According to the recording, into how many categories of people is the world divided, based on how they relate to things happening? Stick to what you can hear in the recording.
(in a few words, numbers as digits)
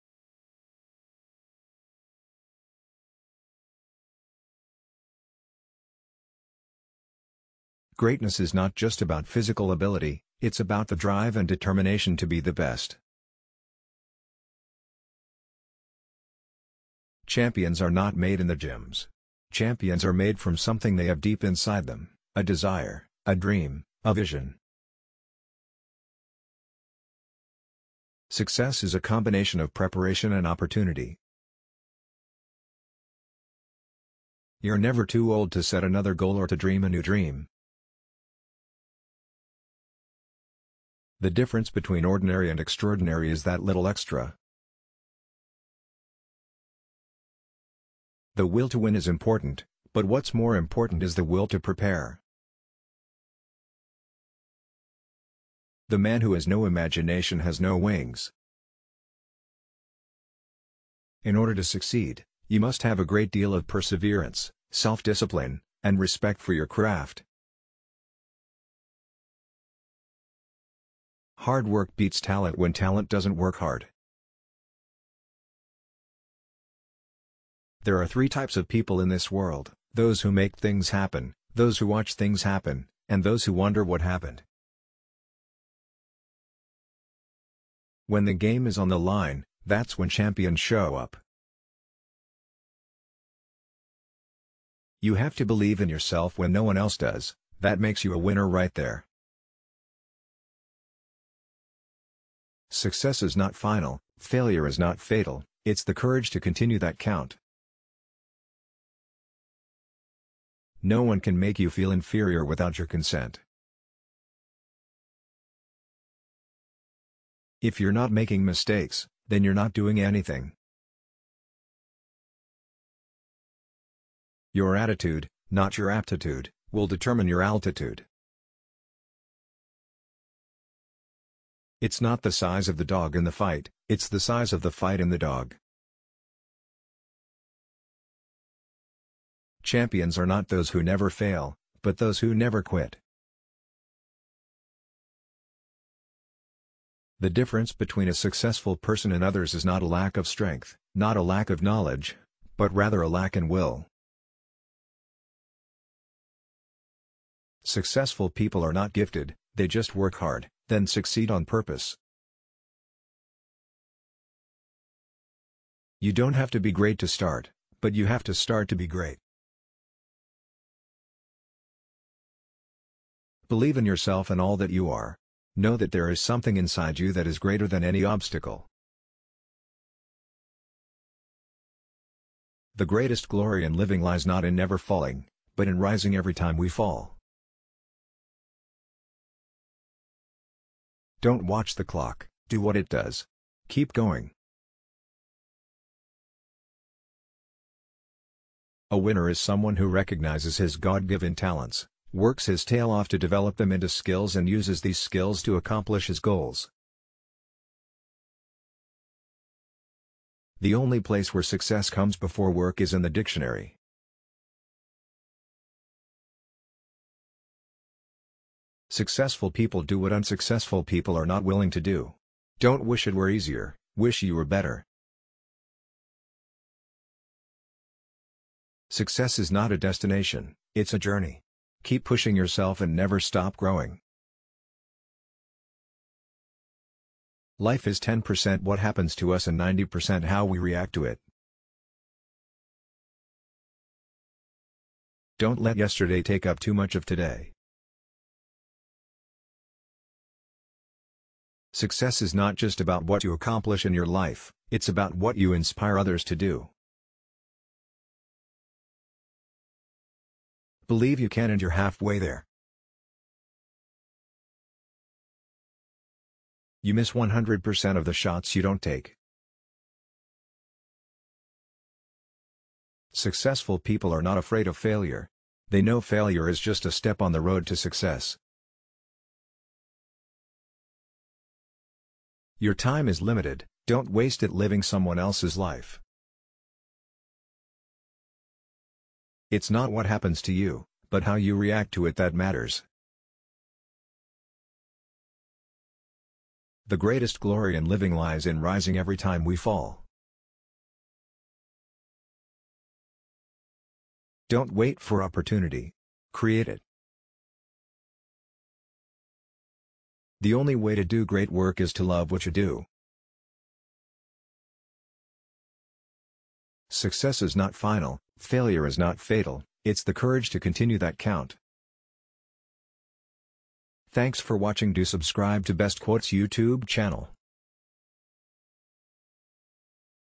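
3.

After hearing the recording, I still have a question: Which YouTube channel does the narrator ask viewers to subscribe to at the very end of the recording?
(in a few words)
Best Quotes.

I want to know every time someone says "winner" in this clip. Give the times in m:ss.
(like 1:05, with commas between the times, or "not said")
1:38, 3:18.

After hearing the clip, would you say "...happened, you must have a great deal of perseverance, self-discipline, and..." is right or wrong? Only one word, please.
wrong.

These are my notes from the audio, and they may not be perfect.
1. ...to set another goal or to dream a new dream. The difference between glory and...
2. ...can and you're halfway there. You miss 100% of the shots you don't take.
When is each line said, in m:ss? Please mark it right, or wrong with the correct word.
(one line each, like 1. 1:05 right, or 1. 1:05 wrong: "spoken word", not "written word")
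1. 0:35 wrong: "ordinary", not "glory"
2. 4:21 right.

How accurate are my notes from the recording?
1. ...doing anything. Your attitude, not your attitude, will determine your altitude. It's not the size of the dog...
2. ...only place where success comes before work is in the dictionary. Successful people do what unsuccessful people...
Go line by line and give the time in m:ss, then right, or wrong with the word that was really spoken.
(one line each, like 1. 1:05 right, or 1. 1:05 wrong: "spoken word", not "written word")
1. 1:59 wrong: "aptitude", not "attitude"
2. 3:30 right.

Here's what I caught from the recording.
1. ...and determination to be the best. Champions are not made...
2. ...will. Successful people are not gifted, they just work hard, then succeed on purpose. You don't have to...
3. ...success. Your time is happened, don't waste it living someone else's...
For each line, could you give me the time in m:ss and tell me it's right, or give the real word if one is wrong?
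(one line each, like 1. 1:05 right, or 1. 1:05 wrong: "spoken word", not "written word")
1. 0:11 right
2. 2:33 right
3. 4:37 wrong: "limited", not "happened".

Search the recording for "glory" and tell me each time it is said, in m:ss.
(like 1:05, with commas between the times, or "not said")
3:03, 4:57.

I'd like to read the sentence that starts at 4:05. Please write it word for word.
Don't let yesterday take up too much of today.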